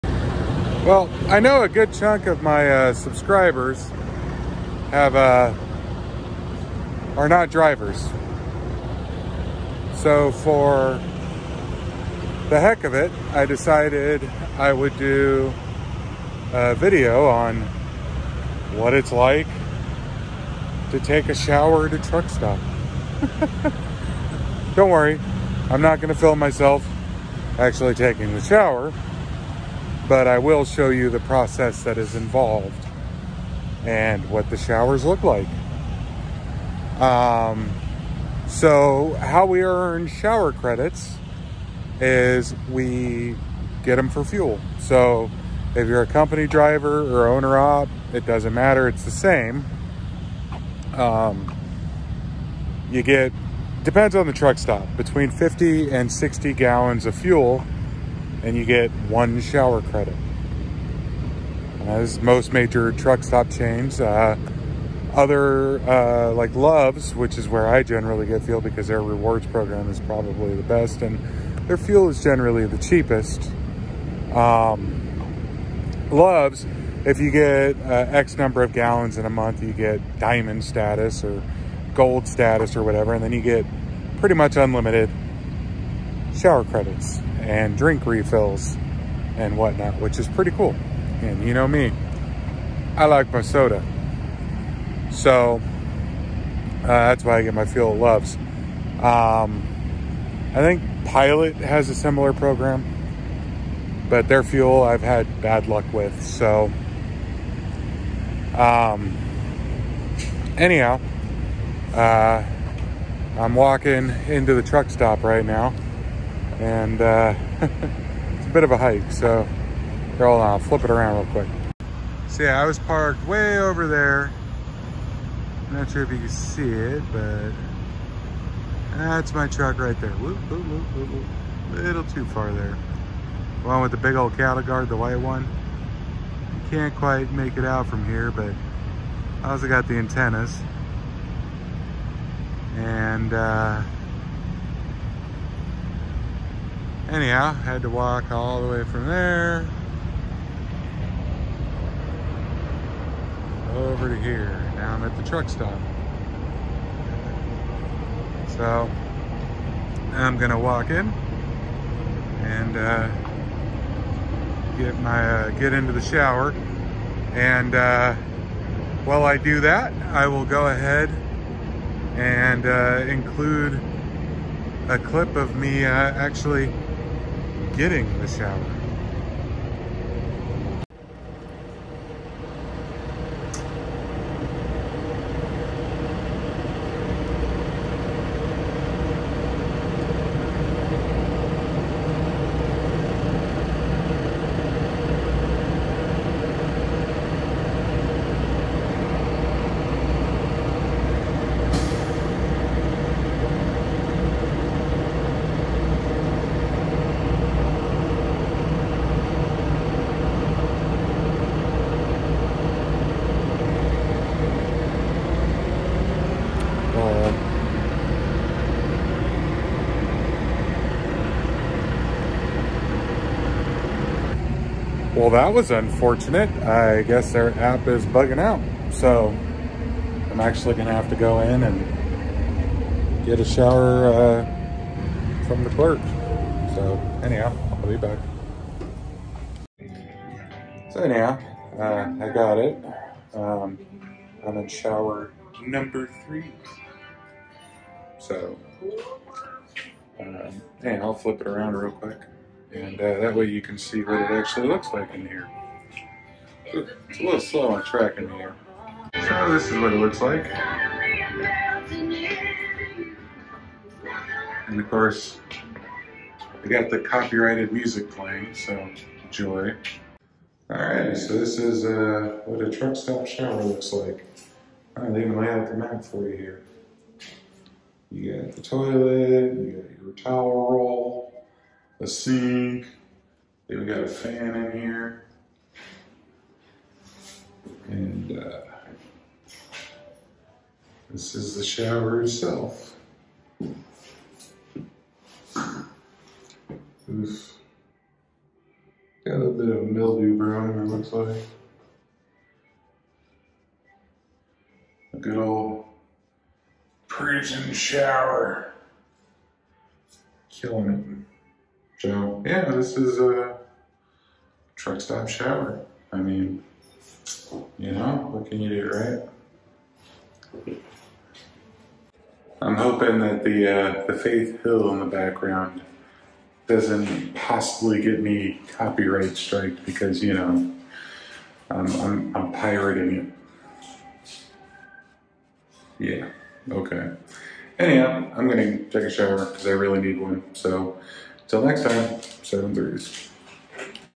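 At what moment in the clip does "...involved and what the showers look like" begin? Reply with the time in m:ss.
0:32.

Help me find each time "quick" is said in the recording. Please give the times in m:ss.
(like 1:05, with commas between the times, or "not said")
2:01, 4:11.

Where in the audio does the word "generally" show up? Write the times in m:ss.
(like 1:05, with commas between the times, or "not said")
1:07, 1:12.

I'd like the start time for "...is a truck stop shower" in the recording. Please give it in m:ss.
5:12.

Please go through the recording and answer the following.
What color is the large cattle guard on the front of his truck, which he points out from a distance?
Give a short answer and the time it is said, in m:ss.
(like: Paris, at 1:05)
White, at 2:14.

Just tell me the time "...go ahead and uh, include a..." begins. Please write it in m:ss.
2:50.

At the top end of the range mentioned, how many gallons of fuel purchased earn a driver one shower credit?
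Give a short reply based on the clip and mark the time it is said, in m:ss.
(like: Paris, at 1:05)
60, at 0:56.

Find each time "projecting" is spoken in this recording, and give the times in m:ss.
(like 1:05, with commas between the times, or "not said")
not said.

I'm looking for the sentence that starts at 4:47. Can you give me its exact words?
And uh, this is the shower itself.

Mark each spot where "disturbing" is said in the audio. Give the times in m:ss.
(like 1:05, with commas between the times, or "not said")
not said.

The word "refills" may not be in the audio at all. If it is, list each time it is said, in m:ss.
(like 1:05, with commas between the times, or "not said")
1:28.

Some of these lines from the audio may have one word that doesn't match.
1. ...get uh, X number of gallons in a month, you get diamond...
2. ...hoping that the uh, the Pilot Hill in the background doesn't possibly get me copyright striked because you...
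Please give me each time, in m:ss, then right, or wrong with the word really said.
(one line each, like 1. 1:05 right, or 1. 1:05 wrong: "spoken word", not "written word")
1. 1:17 right
2. 5:22 wrong: "Faith", not "Pilot".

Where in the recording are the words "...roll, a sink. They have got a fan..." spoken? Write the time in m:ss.
4:40.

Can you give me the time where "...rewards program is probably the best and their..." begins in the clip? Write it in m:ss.
1:09.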